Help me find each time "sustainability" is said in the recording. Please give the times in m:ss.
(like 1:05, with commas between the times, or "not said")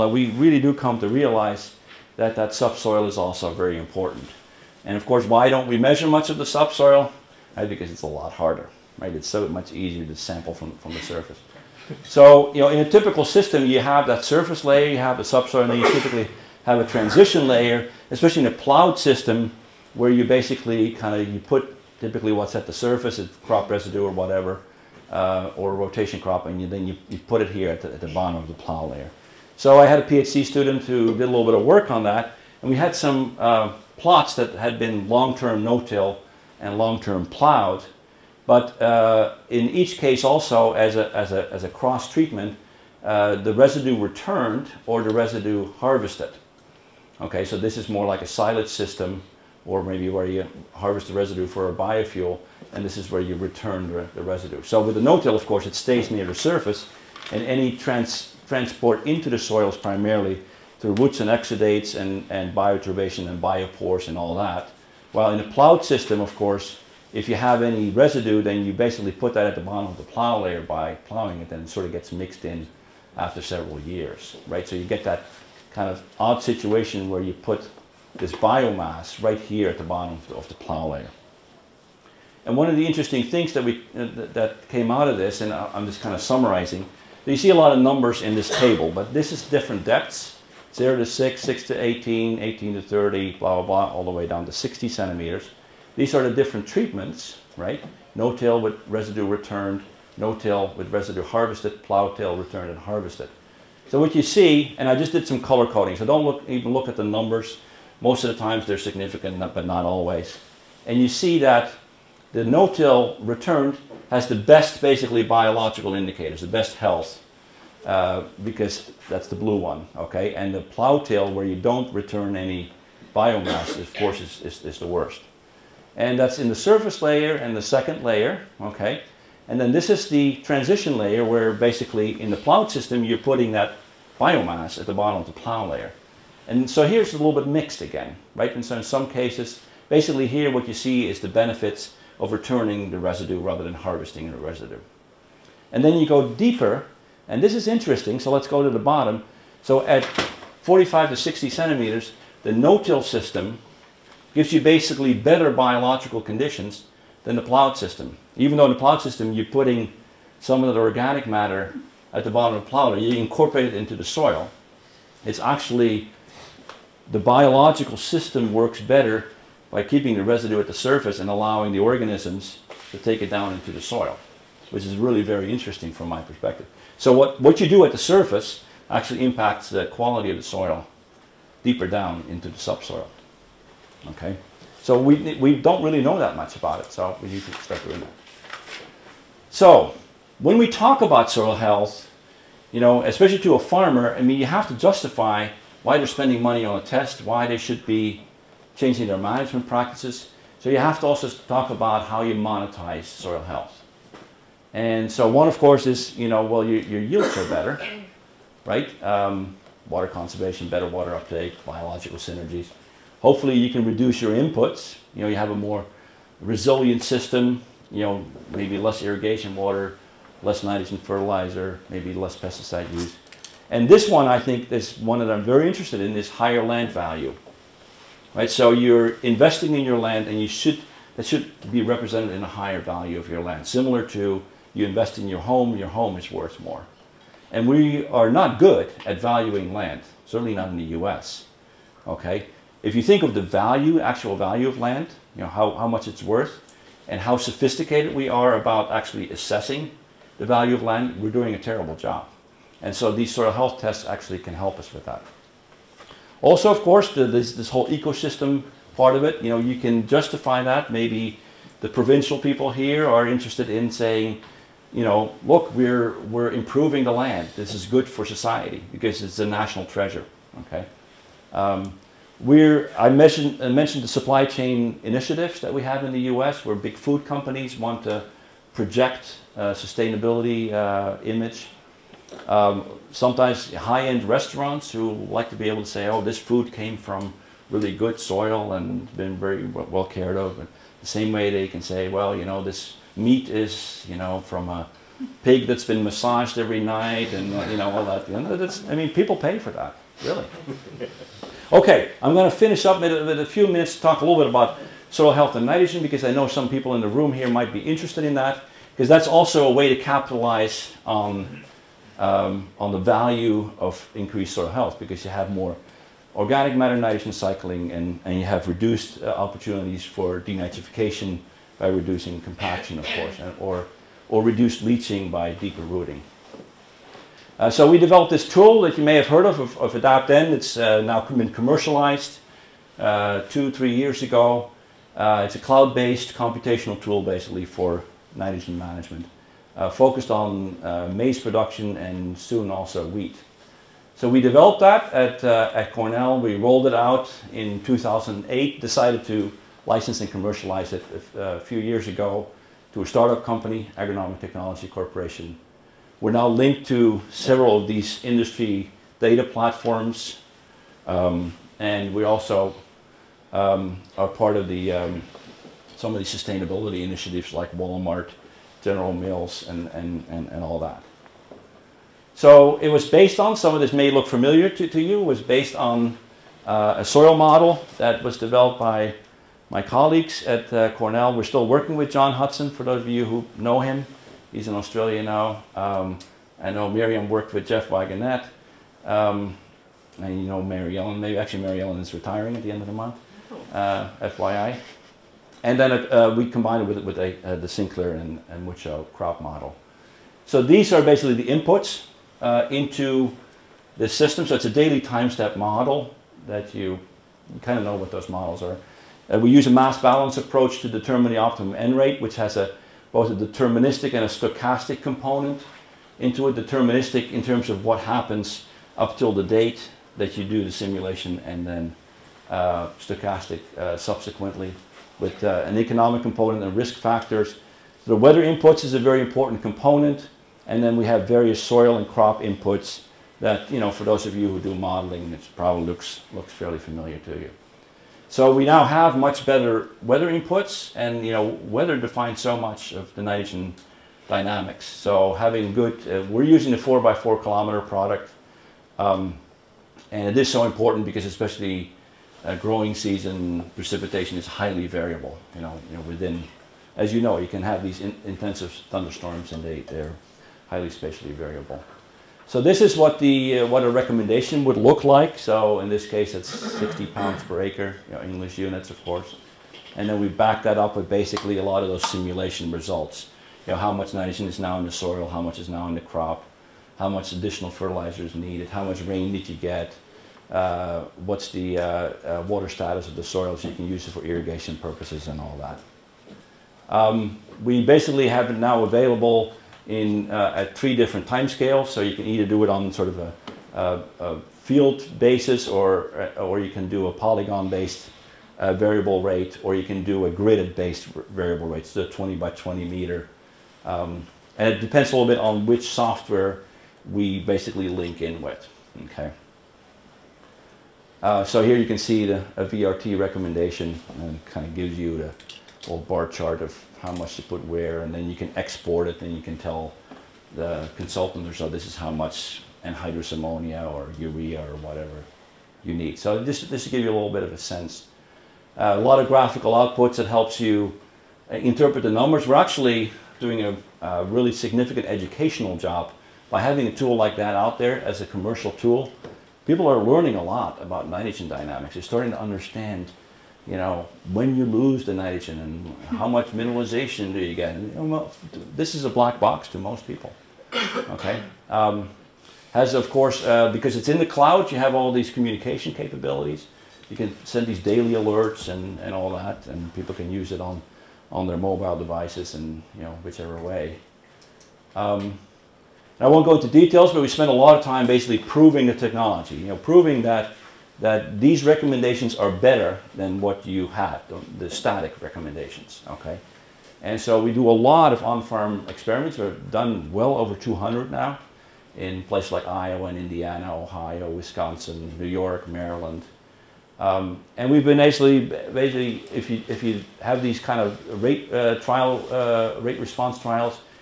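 4:39, 6:06.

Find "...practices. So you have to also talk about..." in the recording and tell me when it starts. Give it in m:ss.
3:19.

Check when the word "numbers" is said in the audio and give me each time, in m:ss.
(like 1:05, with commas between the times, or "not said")
1:27, 1:47, 8:52.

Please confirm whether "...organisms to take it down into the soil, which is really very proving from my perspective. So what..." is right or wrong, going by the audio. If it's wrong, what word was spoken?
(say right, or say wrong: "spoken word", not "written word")
wrong: "interesting", not "proving".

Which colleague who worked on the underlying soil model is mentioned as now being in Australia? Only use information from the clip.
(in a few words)
John Hutson.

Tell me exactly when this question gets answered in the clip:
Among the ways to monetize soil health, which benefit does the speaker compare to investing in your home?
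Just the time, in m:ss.
3:46.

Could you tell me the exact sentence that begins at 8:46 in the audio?
So this this to give you a little bit of a sense.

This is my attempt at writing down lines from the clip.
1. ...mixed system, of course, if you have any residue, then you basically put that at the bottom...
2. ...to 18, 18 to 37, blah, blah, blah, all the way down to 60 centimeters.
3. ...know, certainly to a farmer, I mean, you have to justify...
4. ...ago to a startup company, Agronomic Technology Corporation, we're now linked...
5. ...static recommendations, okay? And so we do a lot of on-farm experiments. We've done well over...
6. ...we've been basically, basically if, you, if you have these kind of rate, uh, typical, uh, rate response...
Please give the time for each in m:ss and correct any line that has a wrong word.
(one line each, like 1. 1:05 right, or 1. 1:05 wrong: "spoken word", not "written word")
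1. 1:05 wrong: "plowed", not "mixed"
2. 1:31 wrong: "30", not "37"
3. 3:12 wrong: "especially", not "certainly"
4. 5:52 right
5. 9:34 right
6. 9:47 wrong: "trial", not "typical".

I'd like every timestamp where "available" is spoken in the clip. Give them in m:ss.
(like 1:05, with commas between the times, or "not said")
8:08.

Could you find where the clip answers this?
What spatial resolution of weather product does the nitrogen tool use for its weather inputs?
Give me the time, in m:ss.
7:26.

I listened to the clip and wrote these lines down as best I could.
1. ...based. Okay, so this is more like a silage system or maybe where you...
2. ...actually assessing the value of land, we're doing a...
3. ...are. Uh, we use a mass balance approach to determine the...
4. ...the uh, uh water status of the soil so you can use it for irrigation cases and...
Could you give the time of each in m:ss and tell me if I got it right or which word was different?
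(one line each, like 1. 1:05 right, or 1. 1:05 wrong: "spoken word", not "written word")
1. 0:45 wrong: "harvested", not "based"
2. 4:08 right
3. 6:48 right
4. 8:01 wrong: "purposes", not "cases".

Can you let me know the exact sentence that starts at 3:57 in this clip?
And we are not good at valuing land, certainly not in the US.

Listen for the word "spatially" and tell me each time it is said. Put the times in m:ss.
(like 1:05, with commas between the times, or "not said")
7:40.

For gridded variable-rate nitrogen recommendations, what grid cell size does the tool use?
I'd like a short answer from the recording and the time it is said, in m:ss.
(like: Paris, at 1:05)
20 by 20 meters, at 8:22.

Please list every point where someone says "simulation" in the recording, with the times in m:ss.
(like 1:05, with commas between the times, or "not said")
7:00, 7:52.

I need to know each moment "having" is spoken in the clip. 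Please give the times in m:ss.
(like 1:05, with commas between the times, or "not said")
7:25, 8:56.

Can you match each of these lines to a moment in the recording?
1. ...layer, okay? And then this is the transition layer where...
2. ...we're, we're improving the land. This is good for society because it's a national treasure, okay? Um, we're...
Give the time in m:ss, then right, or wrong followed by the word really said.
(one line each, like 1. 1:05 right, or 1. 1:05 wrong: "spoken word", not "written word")
1. 2:08 right
2. 4:25 right.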